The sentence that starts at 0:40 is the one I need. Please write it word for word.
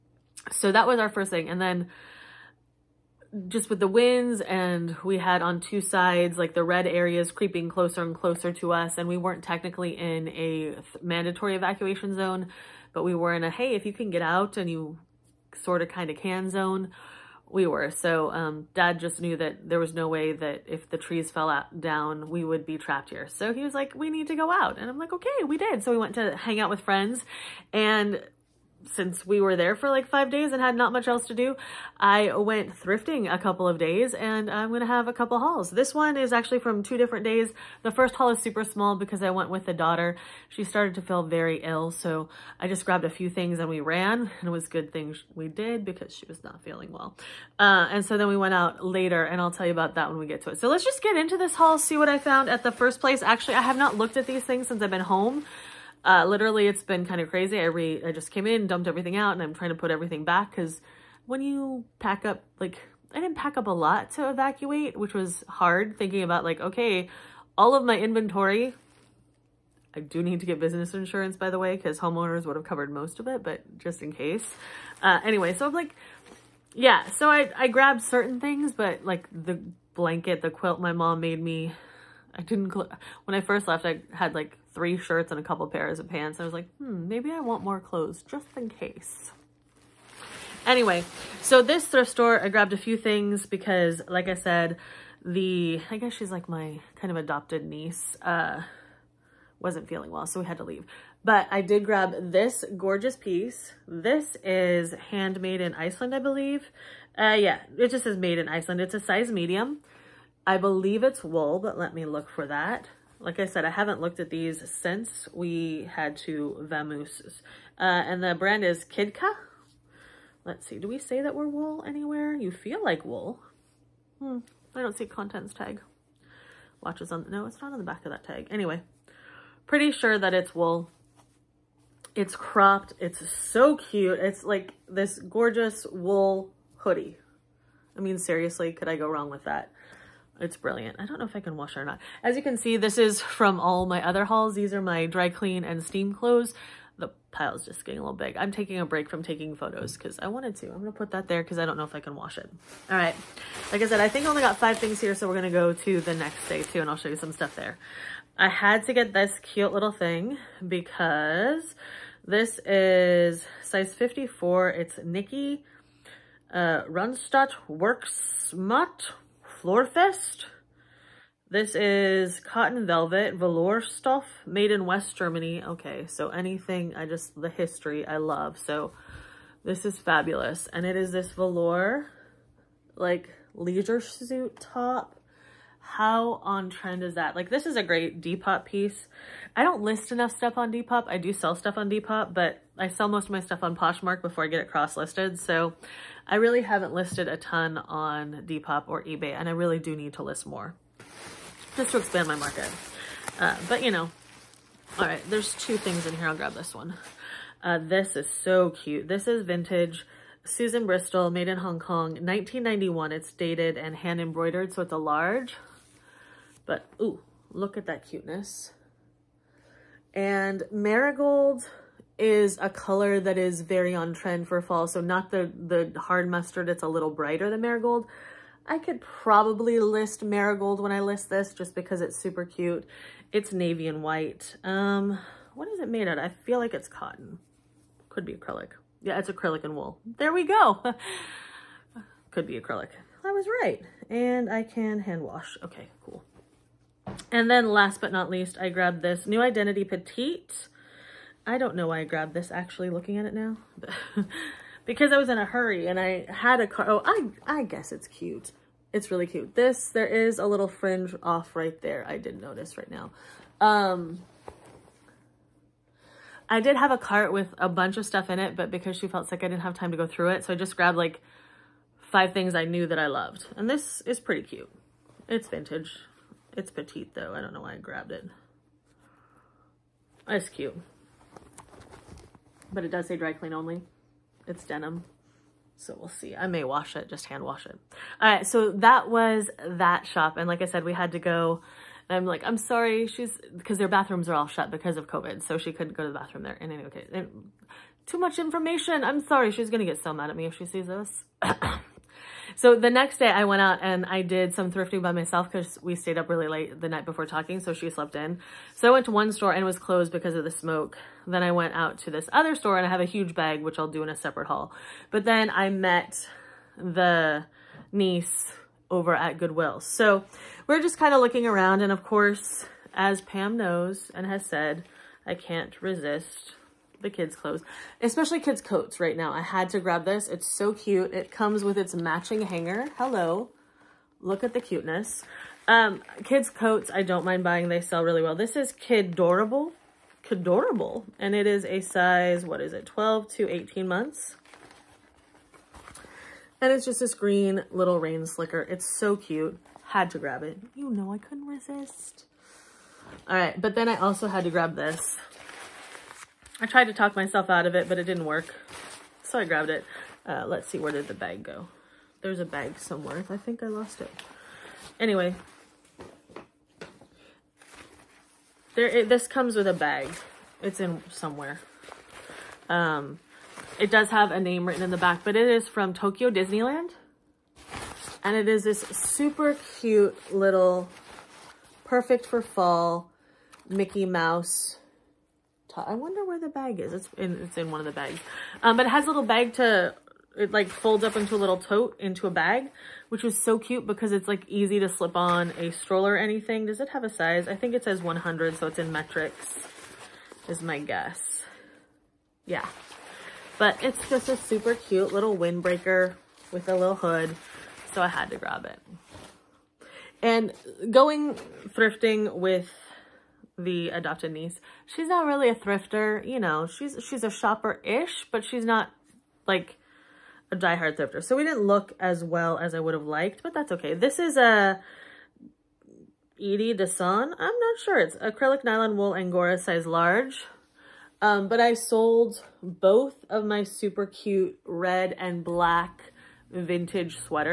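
She started to feel very ill, so I just grabbed a few things and we ran.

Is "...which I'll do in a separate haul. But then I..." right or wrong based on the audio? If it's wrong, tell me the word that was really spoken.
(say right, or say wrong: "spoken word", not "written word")
right.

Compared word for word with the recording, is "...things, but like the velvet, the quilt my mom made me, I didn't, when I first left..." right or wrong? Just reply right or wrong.
wrong.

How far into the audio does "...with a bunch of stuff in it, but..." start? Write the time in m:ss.
4:27.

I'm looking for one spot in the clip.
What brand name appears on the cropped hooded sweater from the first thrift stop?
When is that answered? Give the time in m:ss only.
1:58.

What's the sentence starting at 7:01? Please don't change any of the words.
So we didn't look as well as I would have liked, but that's okay.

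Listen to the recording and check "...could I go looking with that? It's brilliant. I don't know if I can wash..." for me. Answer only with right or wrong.
wrong.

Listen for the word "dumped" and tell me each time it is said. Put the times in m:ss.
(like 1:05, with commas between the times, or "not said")
0:58.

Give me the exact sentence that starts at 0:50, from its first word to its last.
So let's just get into this haul, see what I found at the first place.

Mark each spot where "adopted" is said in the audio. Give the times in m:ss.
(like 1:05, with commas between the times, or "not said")
1:37, 6:53.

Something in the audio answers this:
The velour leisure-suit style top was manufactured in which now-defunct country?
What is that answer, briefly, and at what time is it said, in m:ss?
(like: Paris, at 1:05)
West Germany, at 2:54.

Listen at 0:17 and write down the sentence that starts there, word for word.
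So um, dad just knew that there was no way that if the trees fell out, down, we would be trapped here.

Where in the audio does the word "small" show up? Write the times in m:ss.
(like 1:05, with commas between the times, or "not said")
0:38.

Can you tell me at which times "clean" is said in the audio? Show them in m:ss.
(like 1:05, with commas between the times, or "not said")
2:25, 4:43.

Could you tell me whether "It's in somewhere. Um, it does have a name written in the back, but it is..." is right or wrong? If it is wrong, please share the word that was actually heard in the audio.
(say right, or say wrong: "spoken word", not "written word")
right.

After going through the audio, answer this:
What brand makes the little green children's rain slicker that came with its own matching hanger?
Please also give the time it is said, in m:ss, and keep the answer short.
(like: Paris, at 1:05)
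Kidorable, at 5:38.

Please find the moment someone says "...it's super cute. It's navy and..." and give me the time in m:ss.
3:52.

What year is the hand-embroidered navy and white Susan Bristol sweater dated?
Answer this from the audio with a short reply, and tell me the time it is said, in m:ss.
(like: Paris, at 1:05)
1991, at 3:32.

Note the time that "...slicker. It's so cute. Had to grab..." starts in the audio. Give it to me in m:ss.
5:48.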